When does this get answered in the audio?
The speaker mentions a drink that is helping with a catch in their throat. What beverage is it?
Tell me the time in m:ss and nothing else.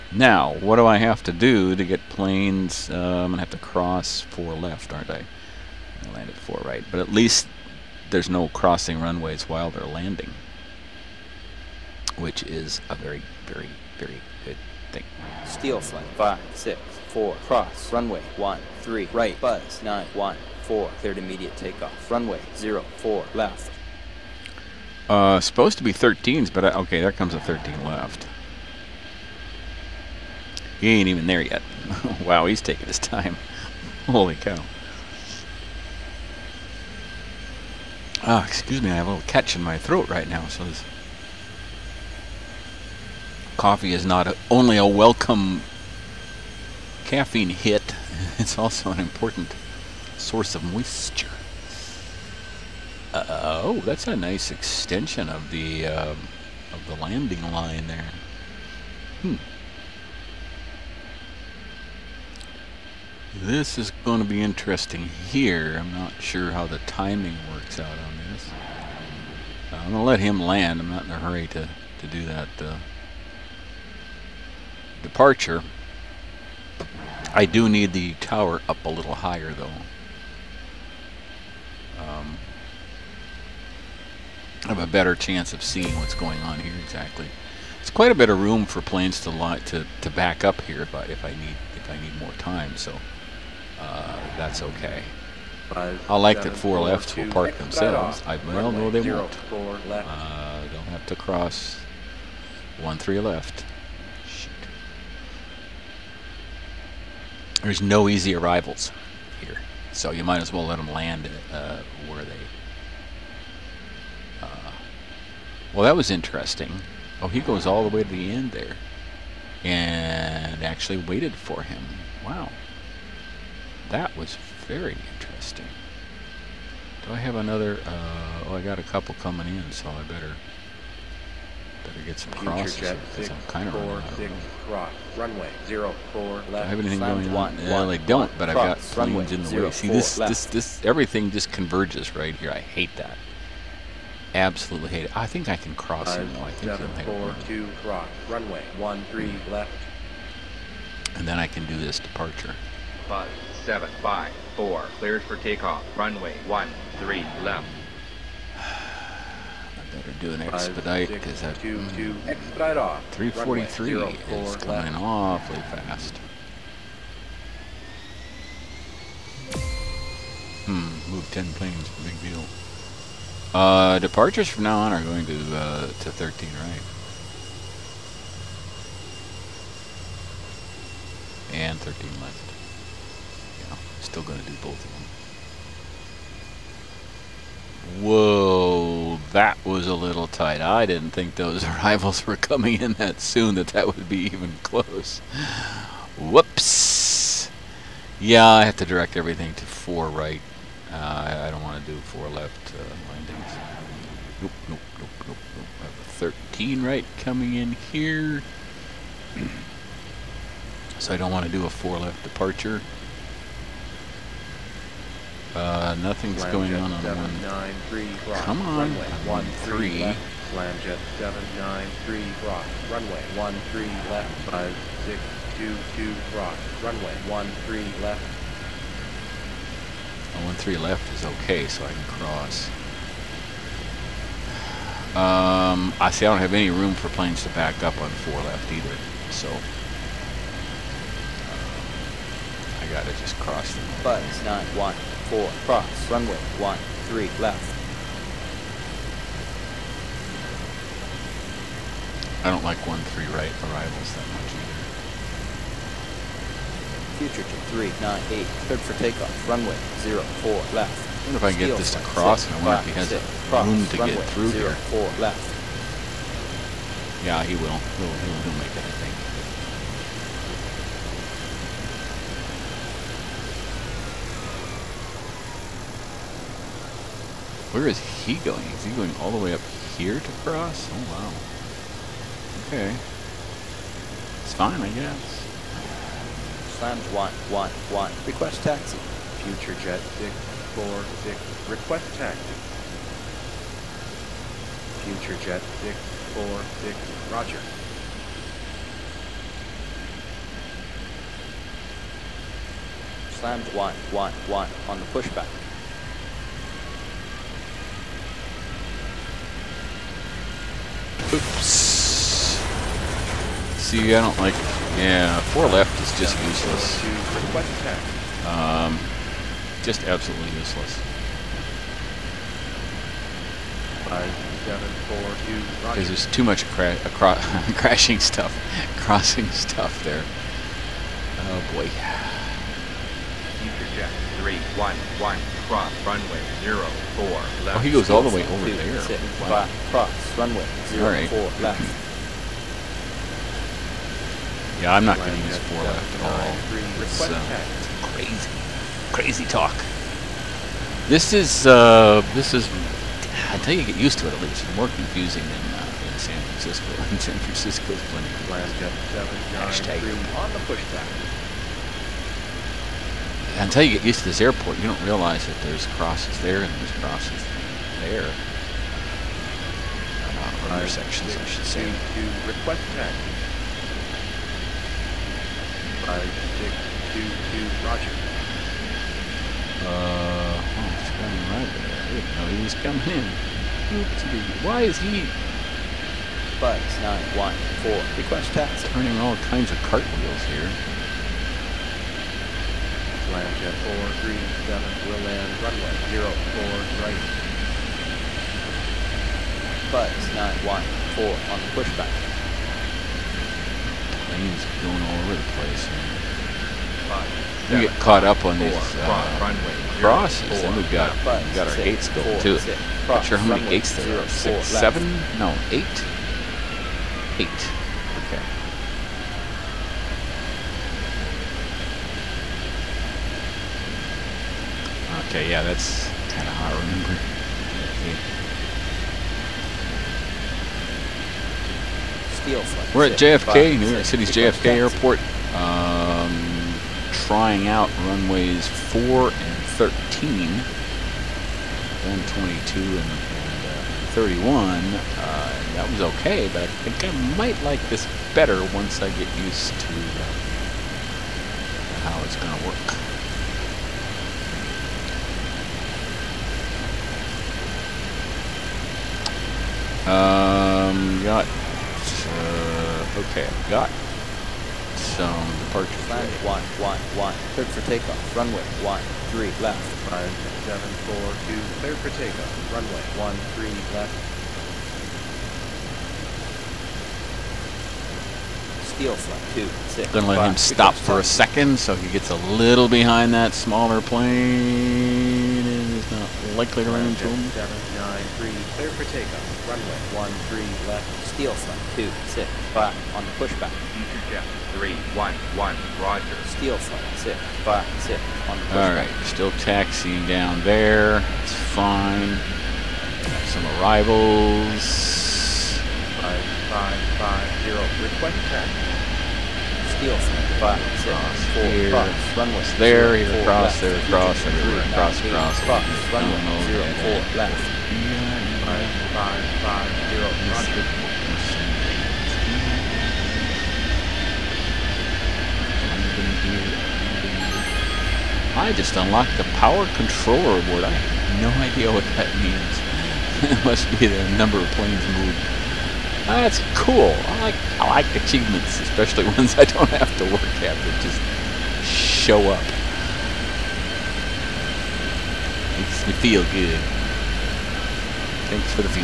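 0:43.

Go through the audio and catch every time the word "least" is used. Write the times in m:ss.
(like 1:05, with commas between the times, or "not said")
0:07, 5:54.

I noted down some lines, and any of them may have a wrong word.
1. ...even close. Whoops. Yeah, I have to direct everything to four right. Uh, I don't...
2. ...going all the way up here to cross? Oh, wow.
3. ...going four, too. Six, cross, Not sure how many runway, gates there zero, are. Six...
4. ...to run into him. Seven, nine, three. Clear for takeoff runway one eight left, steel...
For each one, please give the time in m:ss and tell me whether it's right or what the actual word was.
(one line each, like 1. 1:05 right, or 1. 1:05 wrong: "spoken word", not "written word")
1. 3:14 right
2. 4:38 right
3. 6:52 right
4. 8:06 wrong: "three", not "eight".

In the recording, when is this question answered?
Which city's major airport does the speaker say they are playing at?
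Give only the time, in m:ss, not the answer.
7:13.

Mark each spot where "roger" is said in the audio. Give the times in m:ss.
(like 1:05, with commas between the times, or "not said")
4:57, 6:17, 8:16, 8:40.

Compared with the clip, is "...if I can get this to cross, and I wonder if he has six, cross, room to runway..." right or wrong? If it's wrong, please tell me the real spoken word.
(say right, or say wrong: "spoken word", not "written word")
right.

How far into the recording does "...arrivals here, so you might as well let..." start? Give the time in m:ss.
1:48.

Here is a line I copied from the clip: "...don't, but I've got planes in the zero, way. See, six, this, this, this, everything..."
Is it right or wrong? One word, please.
wrong.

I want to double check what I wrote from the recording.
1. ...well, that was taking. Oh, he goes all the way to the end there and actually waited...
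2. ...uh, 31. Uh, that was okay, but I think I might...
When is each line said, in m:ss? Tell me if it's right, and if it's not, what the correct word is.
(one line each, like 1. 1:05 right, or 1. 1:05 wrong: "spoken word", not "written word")
1. 1:55 wrong: "interesting", not "taking"
2. 7:23 right.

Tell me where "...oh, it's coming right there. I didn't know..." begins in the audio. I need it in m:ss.
6:20.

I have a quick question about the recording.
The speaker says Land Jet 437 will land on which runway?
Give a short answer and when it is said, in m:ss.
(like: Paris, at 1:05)
04 right, at 6:36.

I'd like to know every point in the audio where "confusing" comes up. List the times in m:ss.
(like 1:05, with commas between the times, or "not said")
5:55.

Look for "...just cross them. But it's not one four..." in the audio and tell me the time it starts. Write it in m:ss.
4:03.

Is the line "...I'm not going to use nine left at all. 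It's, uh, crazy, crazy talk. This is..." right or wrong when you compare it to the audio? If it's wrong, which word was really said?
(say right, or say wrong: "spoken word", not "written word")
wrong: "four", not "nine".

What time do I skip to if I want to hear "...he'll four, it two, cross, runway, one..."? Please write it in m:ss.
2:26.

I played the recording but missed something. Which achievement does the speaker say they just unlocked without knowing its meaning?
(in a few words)
power controller board.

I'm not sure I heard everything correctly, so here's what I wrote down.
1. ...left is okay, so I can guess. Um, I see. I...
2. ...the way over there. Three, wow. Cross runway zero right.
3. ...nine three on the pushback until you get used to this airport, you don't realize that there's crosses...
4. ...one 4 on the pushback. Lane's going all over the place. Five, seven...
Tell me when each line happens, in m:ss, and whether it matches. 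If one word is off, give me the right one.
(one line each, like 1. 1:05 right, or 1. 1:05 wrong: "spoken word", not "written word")
1. 3:50 wrong: "cross", not "guess"
2. 5:38 wrong: "Six", not "Three"
3. 5:59 right
4. 6:40 right.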